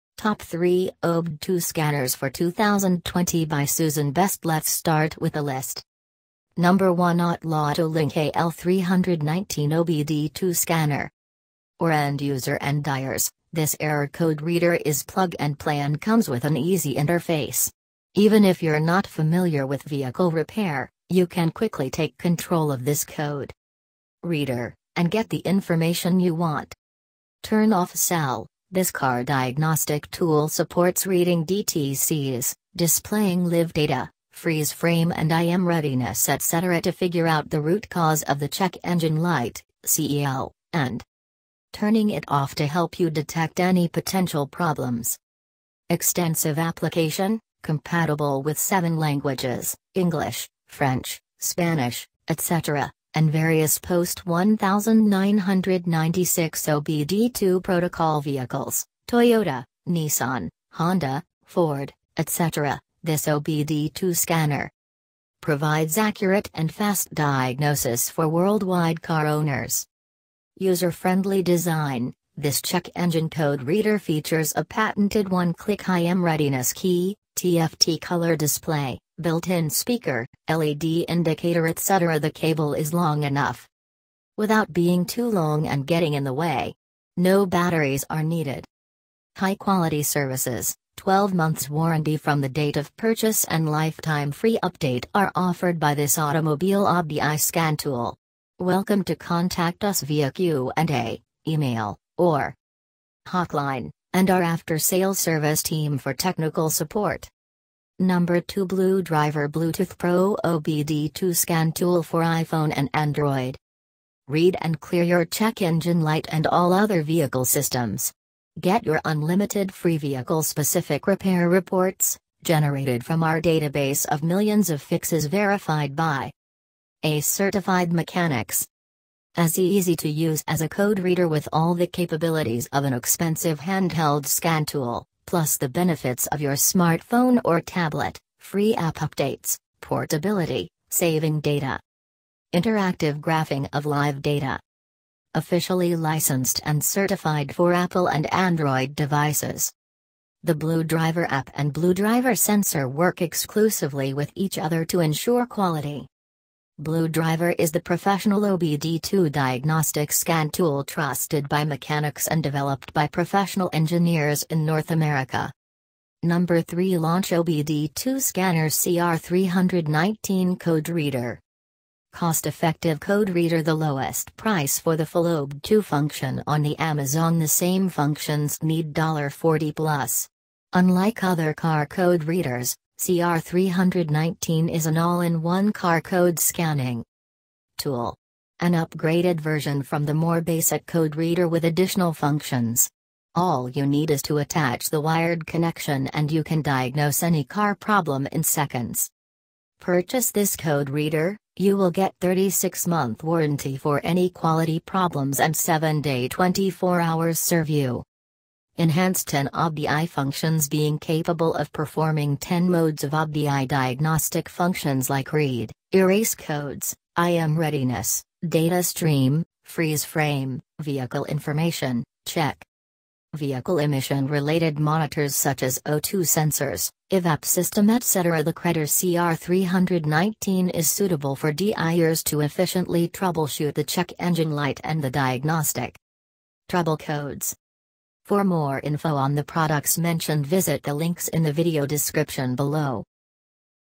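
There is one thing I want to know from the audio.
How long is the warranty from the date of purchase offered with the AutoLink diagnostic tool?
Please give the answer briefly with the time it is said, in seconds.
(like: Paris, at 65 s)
12 months, at 90 s.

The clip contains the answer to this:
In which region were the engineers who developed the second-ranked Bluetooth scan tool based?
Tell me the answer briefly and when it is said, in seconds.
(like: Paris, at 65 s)
North America, at 164 s.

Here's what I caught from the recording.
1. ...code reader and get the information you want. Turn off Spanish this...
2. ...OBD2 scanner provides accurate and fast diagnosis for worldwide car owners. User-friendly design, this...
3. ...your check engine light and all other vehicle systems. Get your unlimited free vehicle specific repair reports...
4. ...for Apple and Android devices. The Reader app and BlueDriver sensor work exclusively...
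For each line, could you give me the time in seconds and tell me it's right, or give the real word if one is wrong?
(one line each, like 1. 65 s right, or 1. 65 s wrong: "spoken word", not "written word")
1. 23 s wrong: "CEL", not "Spanish"
2. 63 s right
3. 115 s right
4. 147 s wrong: "BlueDriver", not "Reader".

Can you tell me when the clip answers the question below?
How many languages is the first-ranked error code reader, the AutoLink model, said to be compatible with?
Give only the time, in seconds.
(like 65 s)
48 s.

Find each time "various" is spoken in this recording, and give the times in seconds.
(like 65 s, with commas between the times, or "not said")
53 s.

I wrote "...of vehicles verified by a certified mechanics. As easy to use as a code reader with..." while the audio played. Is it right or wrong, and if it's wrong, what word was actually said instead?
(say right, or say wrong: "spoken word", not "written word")
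wrong: "fixes", not "vehicles".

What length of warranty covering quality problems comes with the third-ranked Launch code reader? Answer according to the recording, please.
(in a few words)
36 months.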